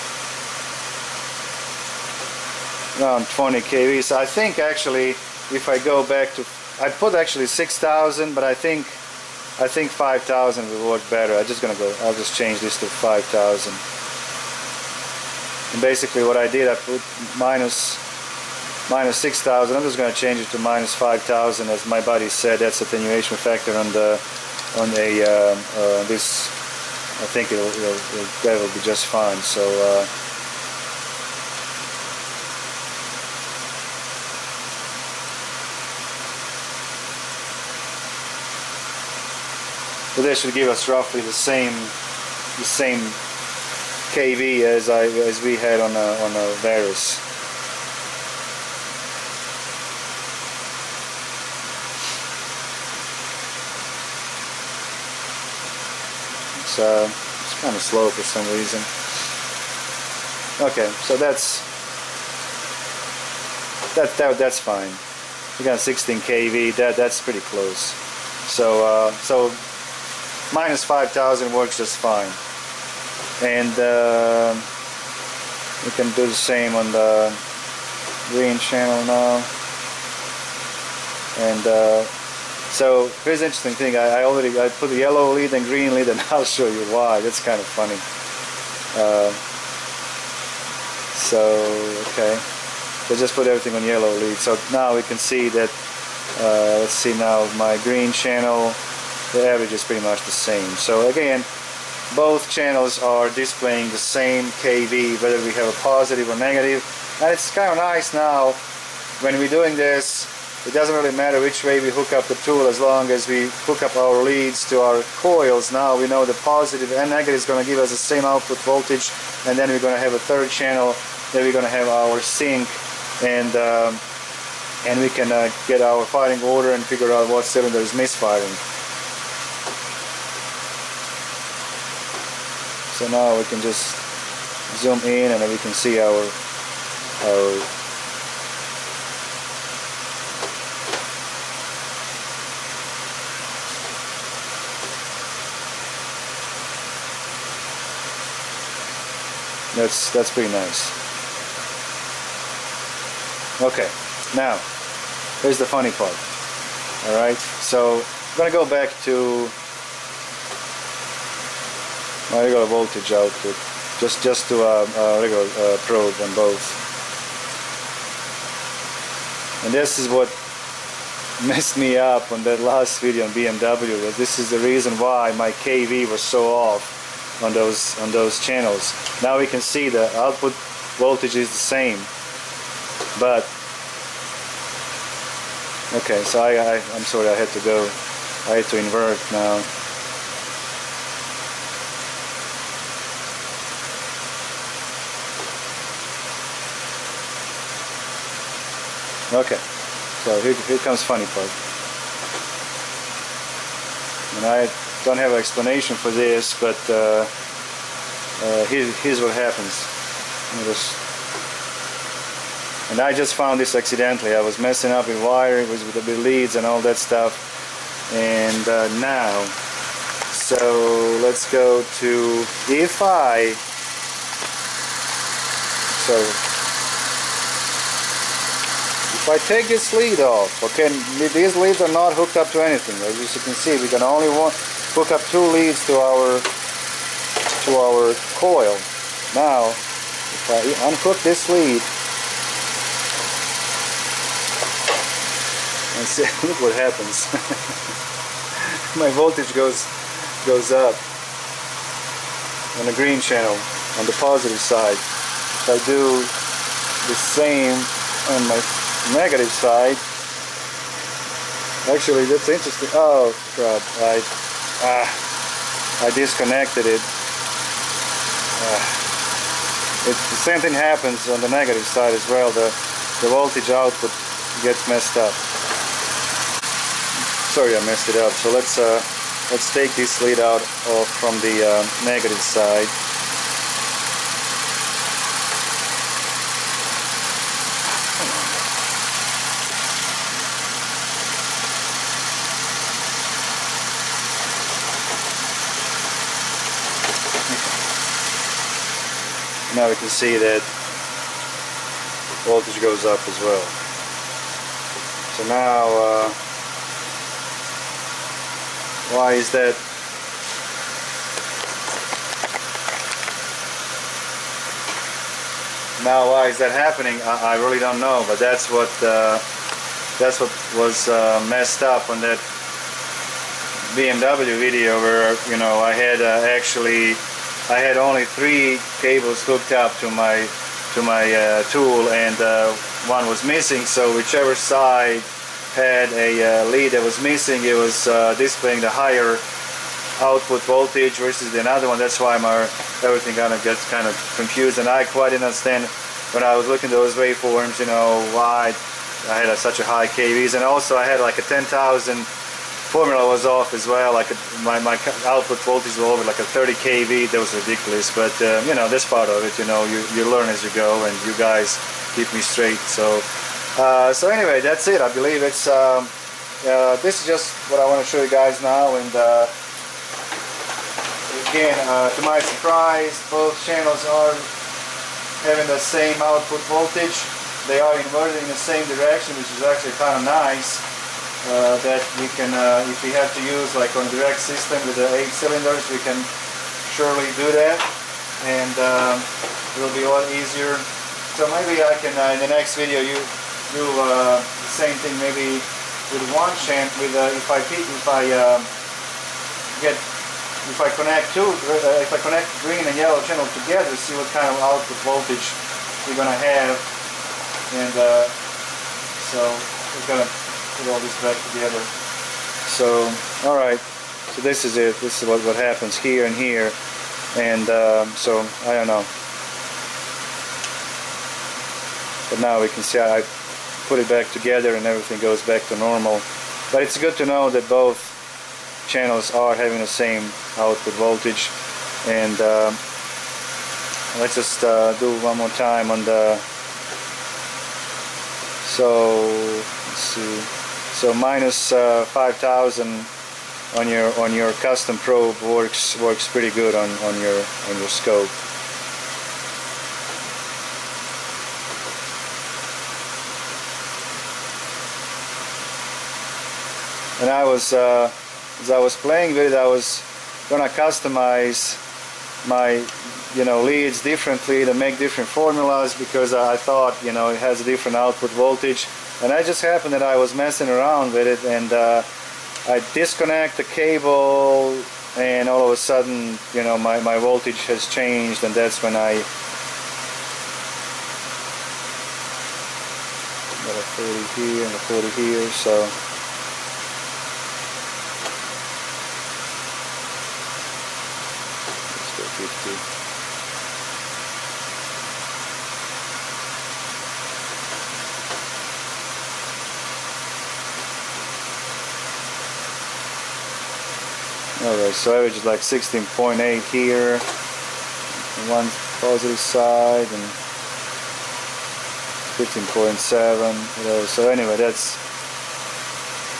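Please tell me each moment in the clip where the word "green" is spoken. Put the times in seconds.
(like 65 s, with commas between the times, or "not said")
78 s, 85 s, 97 s, 252 s, 402 s.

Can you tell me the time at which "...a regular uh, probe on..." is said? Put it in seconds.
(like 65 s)
164 s.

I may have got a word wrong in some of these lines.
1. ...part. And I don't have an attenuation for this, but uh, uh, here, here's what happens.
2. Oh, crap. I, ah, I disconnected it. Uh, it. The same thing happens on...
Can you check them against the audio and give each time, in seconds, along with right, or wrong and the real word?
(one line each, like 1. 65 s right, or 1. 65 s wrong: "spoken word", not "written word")
1. 201 s wrong: "explanation", not "attenuation"
2. 262 s right.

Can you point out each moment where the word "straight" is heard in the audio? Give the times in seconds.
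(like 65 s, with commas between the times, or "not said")
362 s.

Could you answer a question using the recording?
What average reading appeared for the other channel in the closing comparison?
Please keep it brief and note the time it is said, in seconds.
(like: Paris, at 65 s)
15.7, at 512 s.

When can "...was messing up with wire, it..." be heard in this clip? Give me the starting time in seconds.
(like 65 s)
214 s.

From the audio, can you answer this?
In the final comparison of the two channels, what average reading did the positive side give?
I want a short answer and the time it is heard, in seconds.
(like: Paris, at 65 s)
16.8, at 505 s.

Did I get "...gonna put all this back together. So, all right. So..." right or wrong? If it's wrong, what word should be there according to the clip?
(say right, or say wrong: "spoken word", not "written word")
right.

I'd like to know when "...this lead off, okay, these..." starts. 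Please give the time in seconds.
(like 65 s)
229 s.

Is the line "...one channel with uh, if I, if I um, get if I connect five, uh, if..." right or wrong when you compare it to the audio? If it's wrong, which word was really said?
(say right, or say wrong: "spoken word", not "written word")
wrong: "two", not "five".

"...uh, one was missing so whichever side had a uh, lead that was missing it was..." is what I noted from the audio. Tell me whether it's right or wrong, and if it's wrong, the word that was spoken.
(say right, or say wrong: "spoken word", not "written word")
right.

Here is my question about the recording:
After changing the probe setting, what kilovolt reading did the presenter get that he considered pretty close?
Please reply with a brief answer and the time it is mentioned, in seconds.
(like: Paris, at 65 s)
16 kV, at 65 s.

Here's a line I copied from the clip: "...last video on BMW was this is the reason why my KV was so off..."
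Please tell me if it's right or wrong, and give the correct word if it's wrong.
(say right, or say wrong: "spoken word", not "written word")
right.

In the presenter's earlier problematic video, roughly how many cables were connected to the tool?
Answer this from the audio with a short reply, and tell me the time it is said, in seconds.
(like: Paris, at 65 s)
three, at 328 s.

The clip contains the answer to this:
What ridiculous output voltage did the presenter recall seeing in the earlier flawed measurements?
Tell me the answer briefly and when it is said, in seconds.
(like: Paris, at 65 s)
30 kV, at 356 s.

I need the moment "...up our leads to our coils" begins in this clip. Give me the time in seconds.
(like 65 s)
113 s.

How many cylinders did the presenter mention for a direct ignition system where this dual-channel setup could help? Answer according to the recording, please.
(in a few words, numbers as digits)
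eight.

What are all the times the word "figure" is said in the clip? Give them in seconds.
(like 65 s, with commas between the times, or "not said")
126 s.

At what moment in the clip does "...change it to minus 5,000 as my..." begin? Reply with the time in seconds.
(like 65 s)
20 s.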